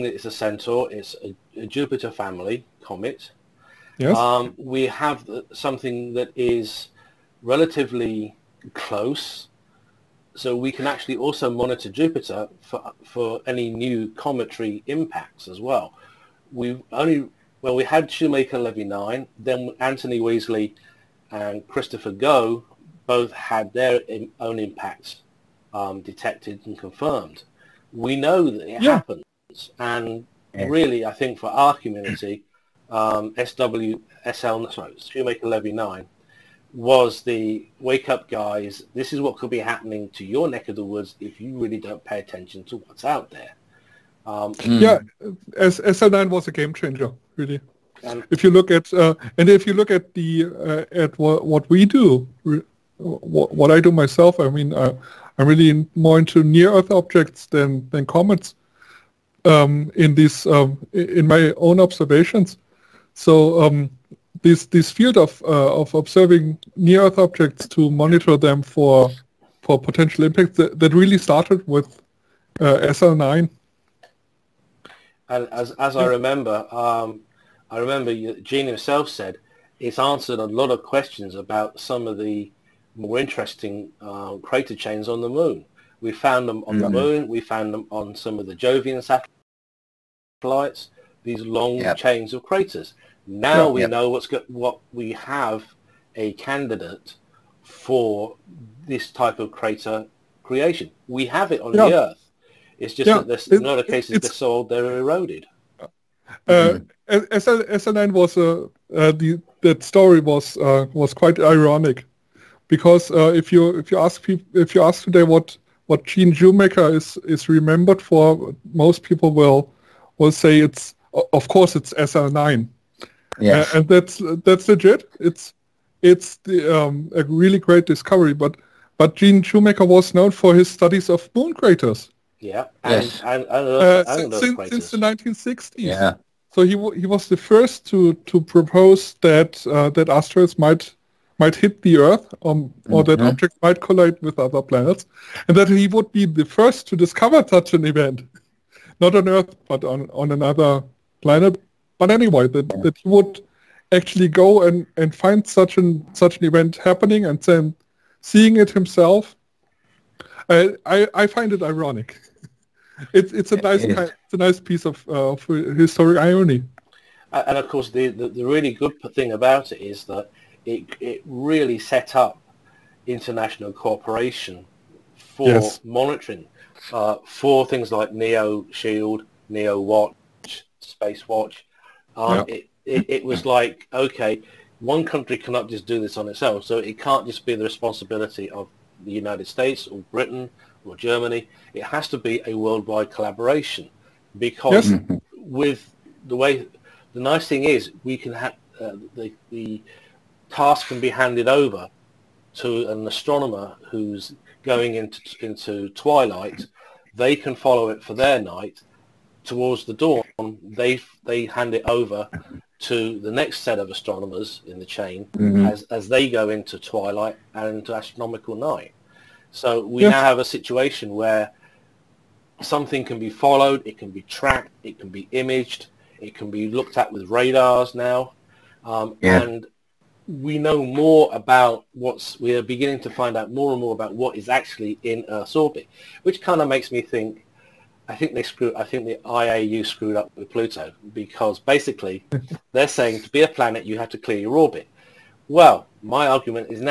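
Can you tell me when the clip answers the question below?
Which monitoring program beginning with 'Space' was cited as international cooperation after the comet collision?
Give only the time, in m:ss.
3:00.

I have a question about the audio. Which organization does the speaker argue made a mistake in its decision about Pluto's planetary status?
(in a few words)
IAU.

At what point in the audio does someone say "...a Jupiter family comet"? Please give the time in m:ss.
0:01.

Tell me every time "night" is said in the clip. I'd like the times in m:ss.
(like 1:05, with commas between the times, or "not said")
3:28, 3:38.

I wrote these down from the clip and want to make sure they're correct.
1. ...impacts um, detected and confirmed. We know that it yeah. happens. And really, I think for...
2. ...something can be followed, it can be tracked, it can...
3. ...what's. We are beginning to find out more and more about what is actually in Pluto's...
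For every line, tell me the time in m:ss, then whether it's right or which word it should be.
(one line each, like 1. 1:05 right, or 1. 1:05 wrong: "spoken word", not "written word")
1. 0:24 right
2. 3:42 right
3. 3:51 wrong: "Earth", not "Pluto".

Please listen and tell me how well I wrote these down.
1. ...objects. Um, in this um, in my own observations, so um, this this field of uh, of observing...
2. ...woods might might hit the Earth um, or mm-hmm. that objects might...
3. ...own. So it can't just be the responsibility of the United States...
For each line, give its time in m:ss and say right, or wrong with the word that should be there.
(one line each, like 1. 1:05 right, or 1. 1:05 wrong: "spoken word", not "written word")
1. 0:58 wrong: "comets", not "objects"
2. 2:20 wrong: "asteroids", not "woods"
3. 3:06 right.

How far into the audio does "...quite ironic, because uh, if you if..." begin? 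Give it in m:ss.
1:51.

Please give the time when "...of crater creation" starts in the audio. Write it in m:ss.
1:39.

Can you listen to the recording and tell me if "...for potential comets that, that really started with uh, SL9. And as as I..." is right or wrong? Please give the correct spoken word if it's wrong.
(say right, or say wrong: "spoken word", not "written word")
wrong: "impacts", not "comets".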